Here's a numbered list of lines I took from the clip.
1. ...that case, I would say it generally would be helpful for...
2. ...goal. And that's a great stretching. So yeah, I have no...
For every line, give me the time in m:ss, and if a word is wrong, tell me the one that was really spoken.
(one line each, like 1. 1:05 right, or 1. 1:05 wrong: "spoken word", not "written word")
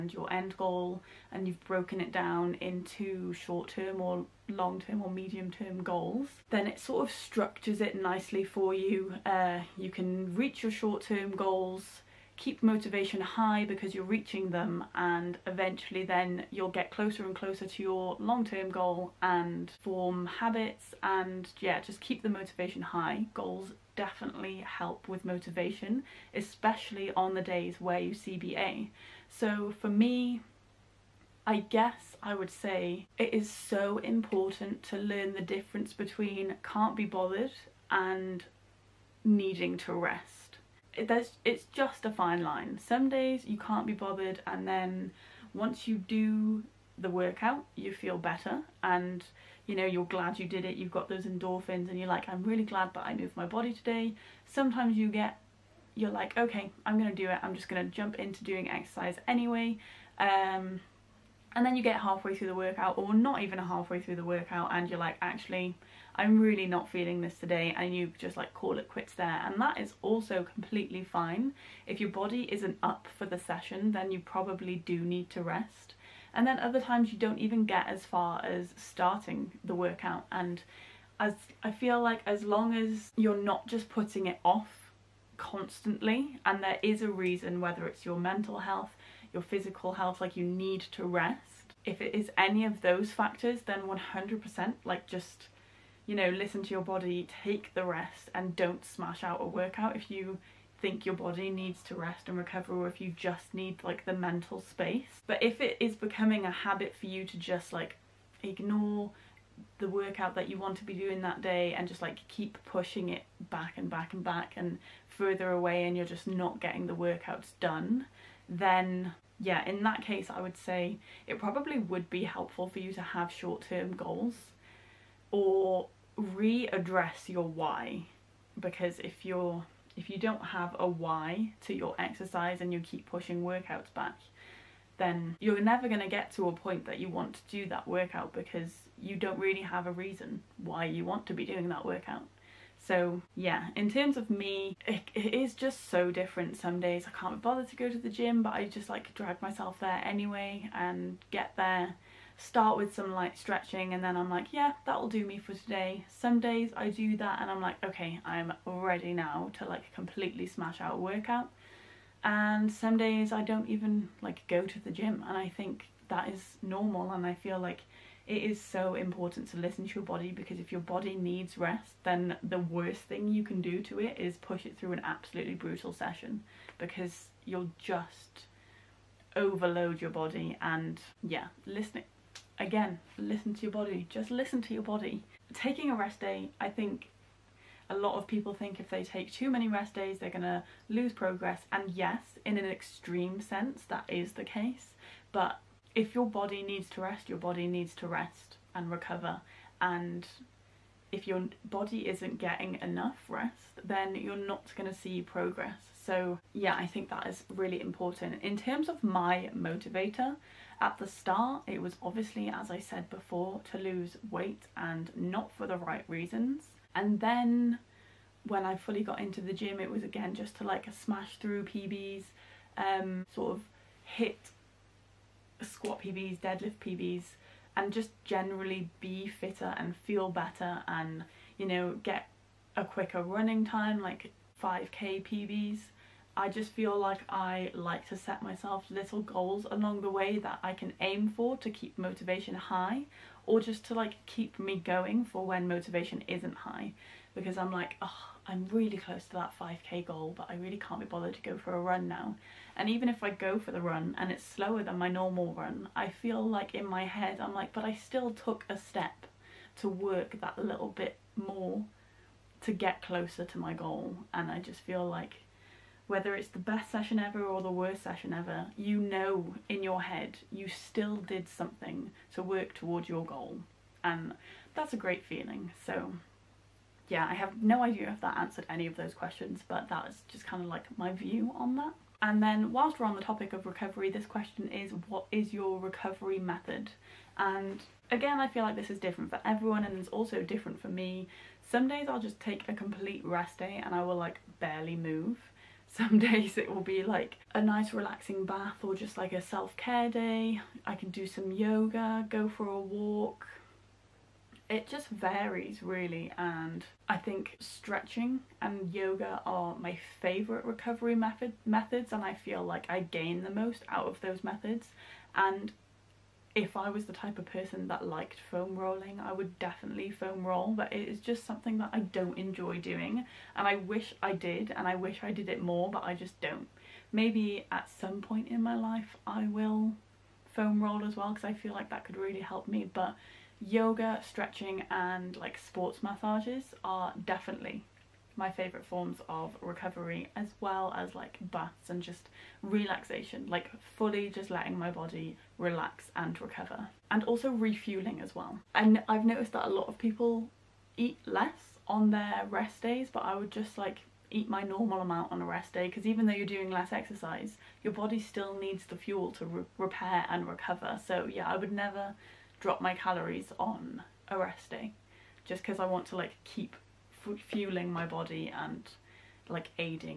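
1. 1:59 wrong: "probably", not "generally"
2. 4:33 wrong: "feeling", not "stretching".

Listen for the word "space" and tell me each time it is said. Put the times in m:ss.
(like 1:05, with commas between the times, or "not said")
1:44.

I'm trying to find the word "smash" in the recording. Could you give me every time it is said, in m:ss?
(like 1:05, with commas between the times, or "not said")
1:38, 2:40, 3:40.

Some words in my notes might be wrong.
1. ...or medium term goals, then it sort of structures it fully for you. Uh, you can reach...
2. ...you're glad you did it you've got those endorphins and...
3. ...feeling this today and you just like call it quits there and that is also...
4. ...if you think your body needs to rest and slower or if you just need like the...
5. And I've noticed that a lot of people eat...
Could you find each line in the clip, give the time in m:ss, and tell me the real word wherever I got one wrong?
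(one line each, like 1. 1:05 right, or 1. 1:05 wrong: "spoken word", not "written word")
1. 0:05 wrong: "nicely", not "fully"
2. 0:49 right
3. 1:06 right
4. 1:39 wrong: "recover", not "slower"
5. 5:48 right.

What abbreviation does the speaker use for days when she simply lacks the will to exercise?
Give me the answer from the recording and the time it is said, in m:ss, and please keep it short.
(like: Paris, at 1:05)
CBA, at 0:28.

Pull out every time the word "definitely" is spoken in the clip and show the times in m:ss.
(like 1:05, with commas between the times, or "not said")
0:23, 5:19, 5:37.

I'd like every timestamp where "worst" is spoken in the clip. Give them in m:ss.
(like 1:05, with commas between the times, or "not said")
2:52, 4:27.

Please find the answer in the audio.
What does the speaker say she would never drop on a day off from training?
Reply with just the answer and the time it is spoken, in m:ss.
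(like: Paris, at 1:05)
Calories, at 6:02.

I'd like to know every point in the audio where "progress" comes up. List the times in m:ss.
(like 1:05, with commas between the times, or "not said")
3:11, 3:25.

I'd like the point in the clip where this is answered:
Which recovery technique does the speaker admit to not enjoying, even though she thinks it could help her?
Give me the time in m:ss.
5:18.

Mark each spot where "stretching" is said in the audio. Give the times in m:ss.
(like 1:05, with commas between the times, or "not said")
2:33, 5:07, 5:34.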